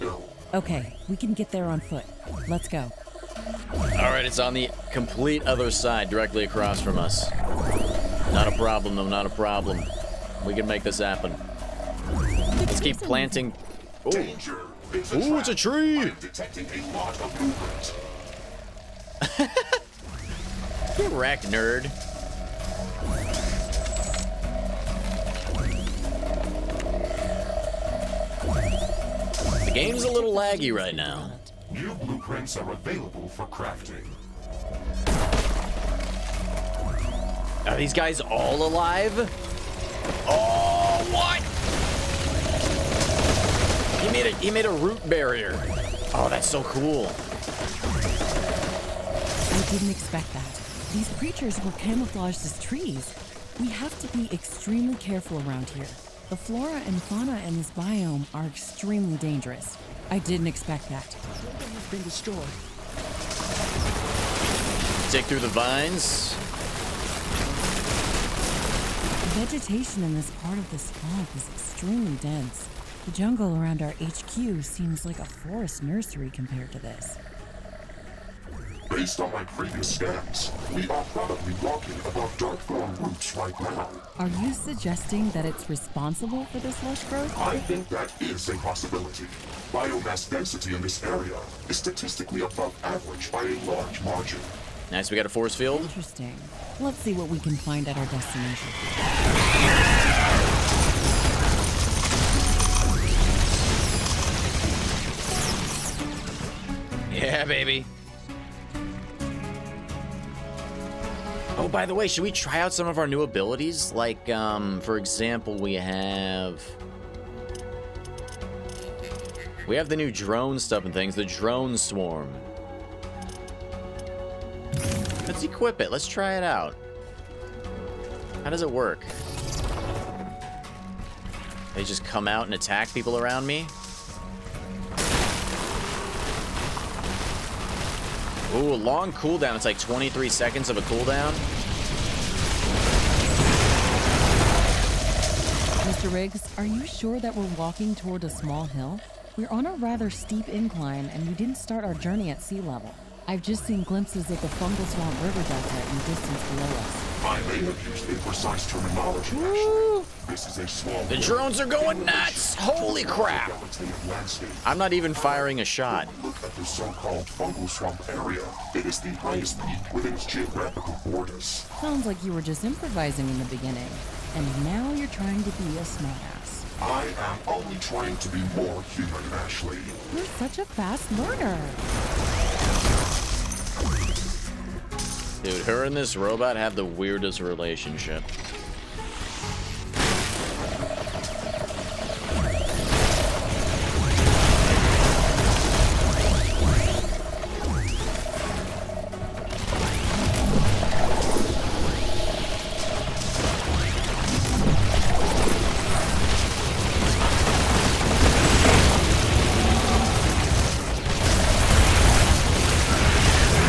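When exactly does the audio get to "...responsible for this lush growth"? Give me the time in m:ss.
1:25.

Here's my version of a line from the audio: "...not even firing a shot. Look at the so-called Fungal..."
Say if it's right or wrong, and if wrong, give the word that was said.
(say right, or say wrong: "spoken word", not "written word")
right.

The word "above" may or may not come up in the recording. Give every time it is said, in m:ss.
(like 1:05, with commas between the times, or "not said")
1:22, 1:32.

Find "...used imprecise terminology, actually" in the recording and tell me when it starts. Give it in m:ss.
2:37.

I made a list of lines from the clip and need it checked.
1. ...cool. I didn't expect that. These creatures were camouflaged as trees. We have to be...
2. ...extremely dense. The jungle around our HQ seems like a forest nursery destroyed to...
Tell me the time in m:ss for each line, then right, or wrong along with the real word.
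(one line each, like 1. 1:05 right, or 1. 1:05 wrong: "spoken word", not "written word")
1. 0:46 right
2. 1:11 wrong: "compared", not "destroyed".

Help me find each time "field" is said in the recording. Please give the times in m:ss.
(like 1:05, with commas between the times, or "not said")
1:35.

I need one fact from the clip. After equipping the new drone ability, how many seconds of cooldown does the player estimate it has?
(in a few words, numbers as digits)
23.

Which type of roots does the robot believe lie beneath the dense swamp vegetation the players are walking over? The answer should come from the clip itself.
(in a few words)
Dark thorn roots.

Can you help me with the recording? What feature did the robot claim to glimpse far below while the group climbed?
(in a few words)
Fungal Swamp River Delta.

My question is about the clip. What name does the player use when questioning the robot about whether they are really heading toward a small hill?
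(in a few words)
Mr. Riggs.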